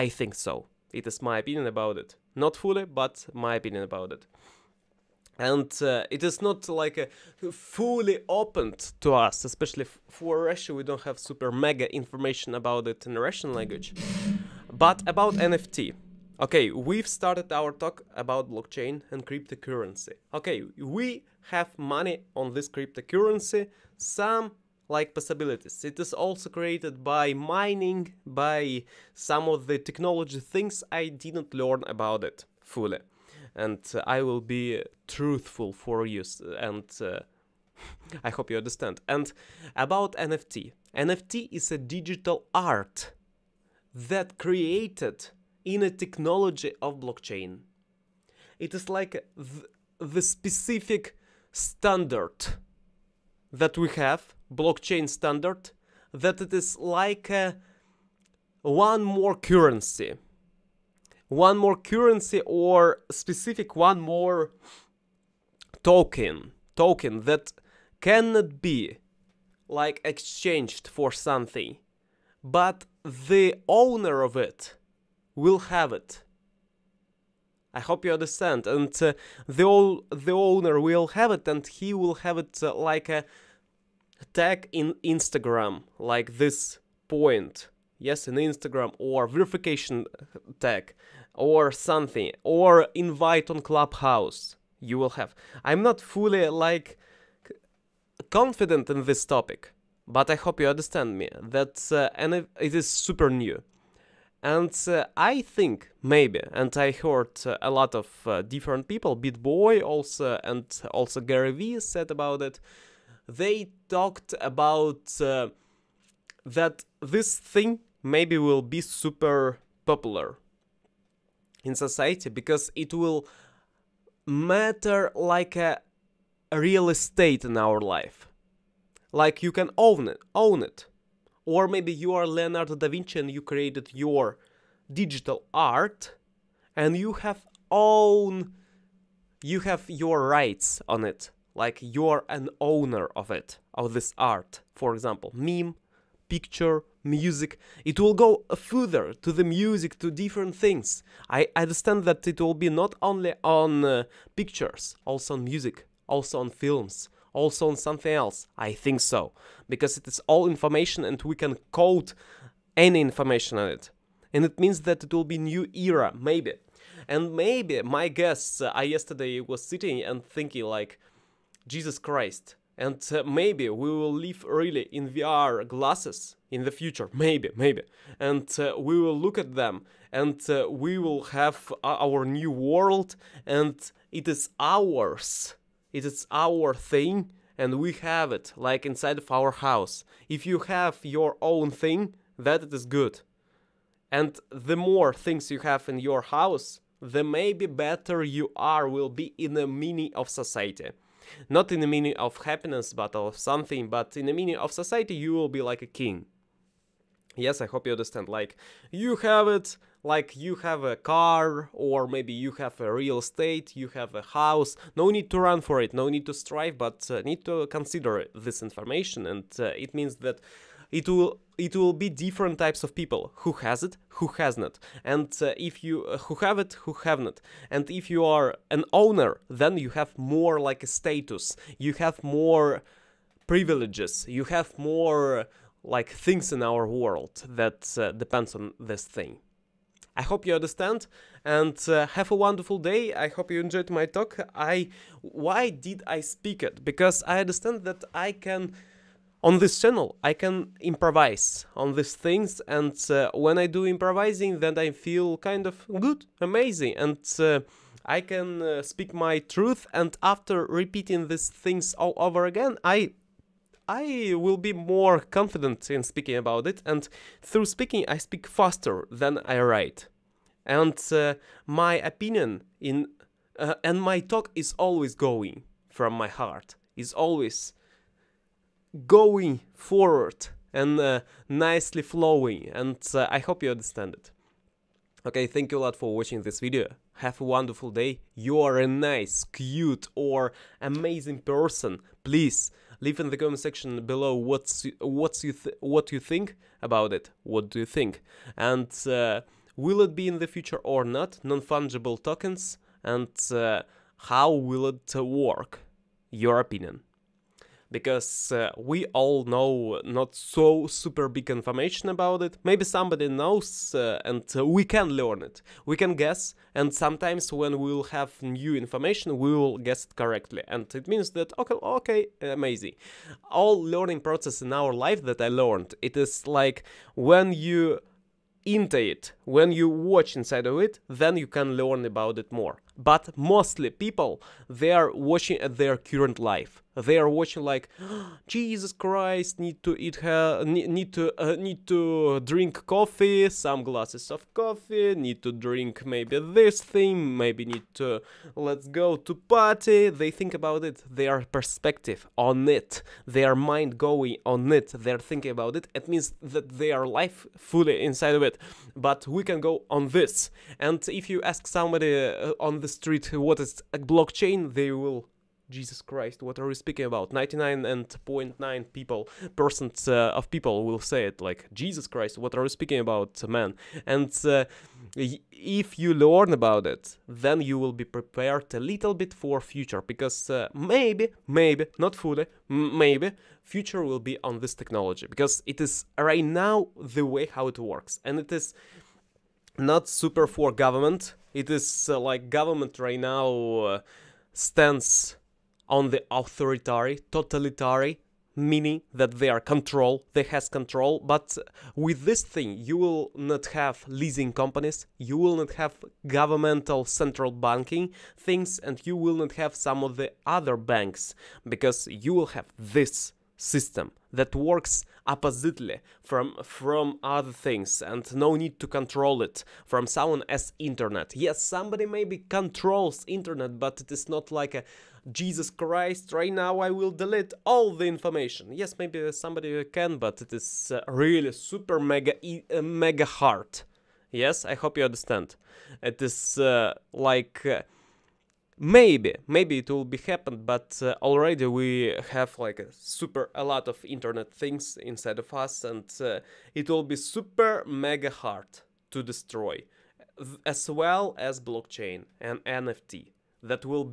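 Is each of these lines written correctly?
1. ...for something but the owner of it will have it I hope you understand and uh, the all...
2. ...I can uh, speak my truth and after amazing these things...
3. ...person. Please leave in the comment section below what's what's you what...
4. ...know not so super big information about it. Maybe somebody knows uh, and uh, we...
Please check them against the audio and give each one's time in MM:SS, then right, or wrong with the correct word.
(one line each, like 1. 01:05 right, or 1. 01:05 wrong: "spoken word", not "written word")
1. 01:10 right
2. 04:18 wrong: "repeating", not "amazing"
3. 04:51 right
4. 05:09 right.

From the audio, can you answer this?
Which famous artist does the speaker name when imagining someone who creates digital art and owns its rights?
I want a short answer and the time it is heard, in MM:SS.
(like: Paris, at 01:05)
Leonardo da Vinci, at 02:12.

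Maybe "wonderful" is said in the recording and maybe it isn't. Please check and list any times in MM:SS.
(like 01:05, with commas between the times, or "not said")
04:02, 04:47.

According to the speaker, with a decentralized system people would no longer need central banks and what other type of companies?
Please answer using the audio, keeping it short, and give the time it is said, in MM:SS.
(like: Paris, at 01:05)
Leasing companies, at 06:44.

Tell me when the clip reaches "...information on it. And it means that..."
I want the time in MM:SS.
02:43.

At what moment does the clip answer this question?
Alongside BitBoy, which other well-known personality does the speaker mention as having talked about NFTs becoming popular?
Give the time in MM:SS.
01:51.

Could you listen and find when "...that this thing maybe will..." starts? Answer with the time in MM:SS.
01:56.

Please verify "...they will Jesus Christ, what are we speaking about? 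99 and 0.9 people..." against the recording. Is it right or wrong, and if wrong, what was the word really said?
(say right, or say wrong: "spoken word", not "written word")
right.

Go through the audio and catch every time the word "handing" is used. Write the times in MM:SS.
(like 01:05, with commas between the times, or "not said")
not said.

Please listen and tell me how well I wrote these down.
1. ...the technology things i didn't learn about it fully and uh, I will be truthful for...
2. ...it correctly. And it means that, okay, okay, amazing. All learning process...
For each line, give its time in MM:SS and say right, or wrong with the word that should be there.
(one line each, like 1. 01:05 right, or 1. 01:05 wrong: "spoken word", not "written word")
1. 00:29 right
2. 05:20 right.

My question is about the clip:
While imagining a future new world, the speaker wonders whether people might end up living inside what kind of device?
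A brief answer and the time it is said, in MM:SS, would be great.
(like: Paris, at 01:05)
VR glasses, at 02:55.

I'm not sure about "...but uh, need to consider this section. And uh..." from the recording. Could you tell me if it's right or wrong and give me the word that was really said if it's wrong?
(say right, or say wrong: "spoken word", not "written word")
wrong: "information", not "section".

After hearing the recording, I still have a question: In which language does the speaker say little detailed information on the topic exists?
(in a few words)
Russian.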